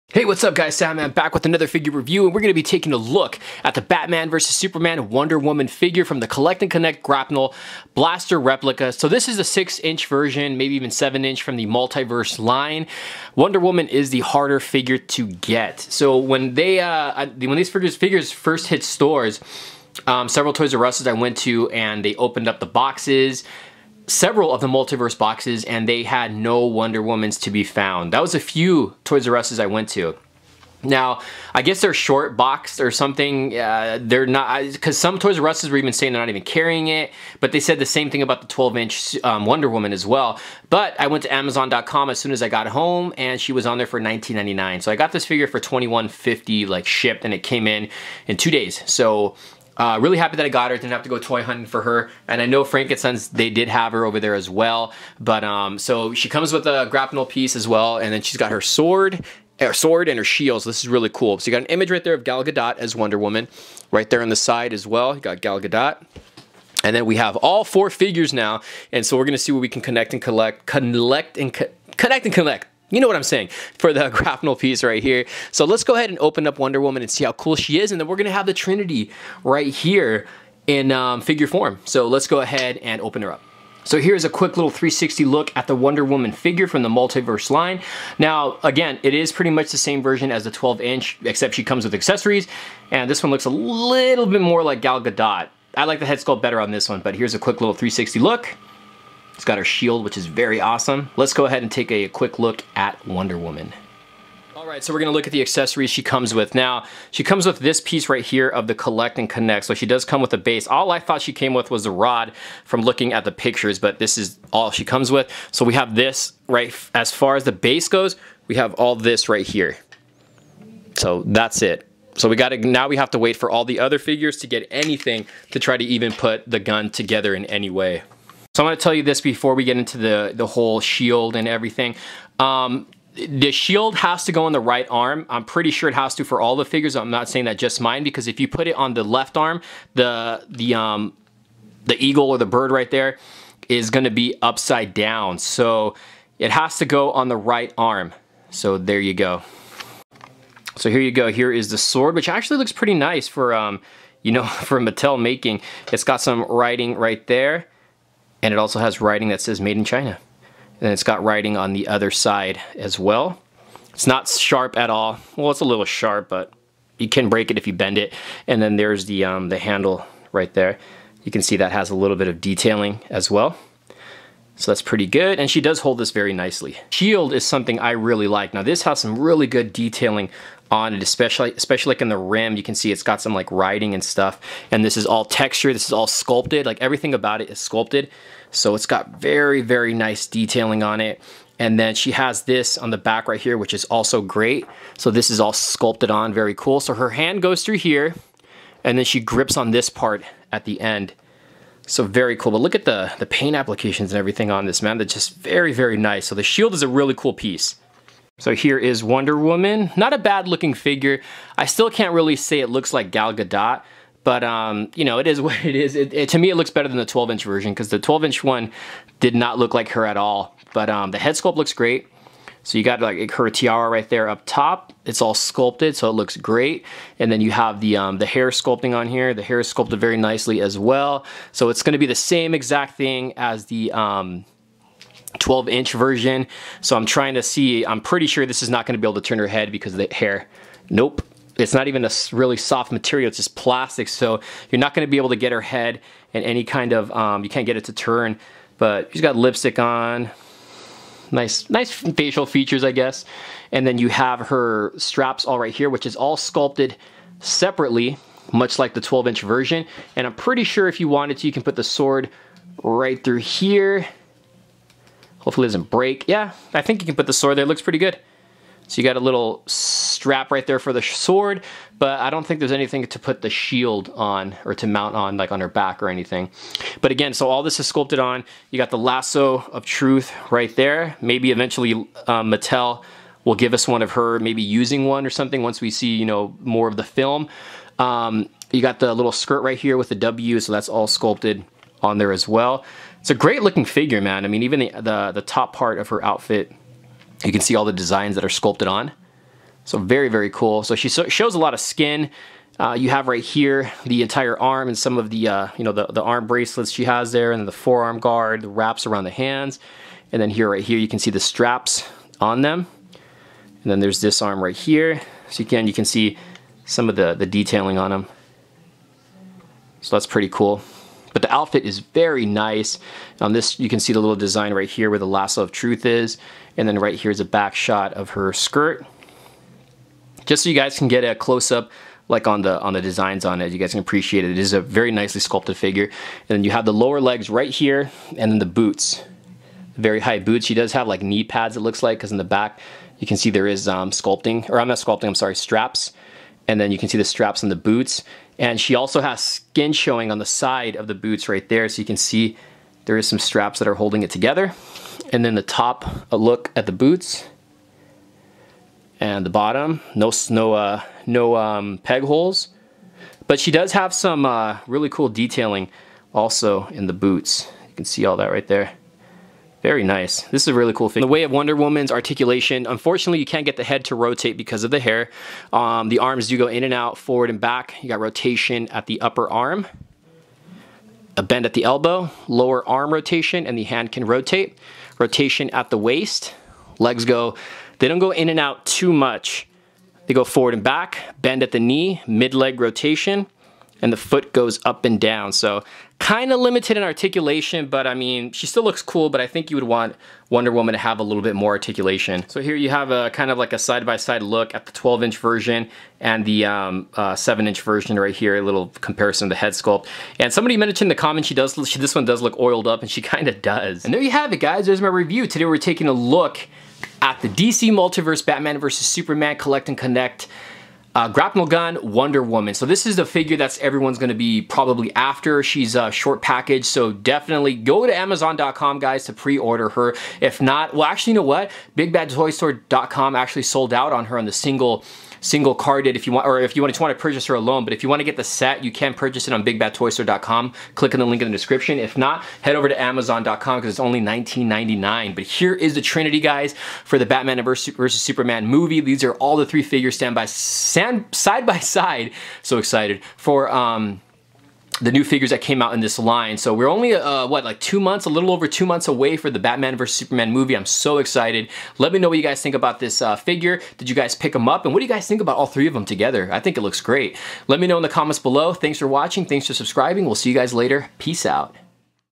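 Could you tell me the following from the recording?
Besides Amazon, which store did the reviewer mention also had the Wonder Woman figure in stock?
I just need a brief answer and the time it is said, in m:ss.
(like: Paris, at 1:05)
Frankenstein's, at 0:52.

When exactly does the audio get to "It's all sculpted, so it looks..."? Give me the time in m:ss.
3:45.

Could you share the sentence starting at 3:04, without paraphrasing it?
And this is all texture, this is all sculpted, like everything about it is sculpted.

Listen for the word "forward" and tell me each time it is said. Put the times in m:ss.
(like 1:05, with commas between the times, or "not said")
6:17, 6:30.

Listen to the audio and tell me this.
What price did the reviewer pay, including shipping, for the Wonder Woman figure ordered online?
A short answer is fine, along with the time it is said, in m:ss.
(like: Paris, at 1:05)
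$21.50, at 0:45.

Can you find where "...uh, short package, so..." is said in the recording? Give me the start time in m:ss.
7:06.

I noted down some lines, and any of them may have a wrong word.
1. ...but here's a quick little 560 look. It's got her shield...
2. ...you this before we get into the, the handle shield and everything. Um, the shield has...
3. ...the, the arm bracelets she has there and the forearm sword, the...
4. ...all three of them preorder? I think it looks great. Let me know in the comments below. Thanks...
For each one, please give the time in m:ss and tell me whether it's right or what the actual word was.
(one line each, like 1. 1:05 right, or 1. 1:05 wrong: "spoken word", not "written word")
1. 1:36 wrong: "360", not "560"
2. 2:08 wrong: "whole", not "handle"
3. 5:05 wrong: "guard", not "sword"
4. 7:45 wrong: "together", not "preorder".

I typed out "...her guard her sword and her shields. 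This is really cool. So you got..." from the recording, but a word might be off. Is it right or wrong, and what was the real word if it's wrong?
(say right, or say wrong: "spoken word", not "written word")
wrong: "sword", not "guard".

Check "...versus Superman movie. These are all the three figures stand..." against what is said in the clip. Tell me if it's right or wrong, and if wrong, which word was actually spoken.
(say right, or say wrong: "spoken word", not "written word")
right.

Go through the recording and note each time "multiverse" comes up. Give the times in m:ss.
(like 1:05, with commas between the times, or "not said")
0:11, 0:24, 1:26, 6:57.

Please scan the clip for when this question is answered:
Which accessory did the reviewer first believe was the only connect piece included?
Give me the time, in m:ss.
1:51.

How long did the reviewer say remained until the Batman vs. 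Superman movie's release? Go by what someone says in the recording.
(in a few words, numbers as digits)
A little over two months.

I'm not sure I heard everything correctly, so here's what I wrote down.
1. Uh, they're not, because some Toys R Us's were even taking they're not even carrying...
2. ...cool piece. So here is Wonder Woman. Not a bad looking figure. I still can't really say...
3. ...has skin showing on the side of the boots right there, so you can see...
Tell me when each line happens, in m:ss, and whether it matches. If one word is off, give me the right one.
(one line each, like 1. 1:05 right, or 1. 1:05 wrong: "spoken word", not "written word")
1. 0:33 wrong: "saying", not "taking"
2. 3:27 right
3. 5:49 right.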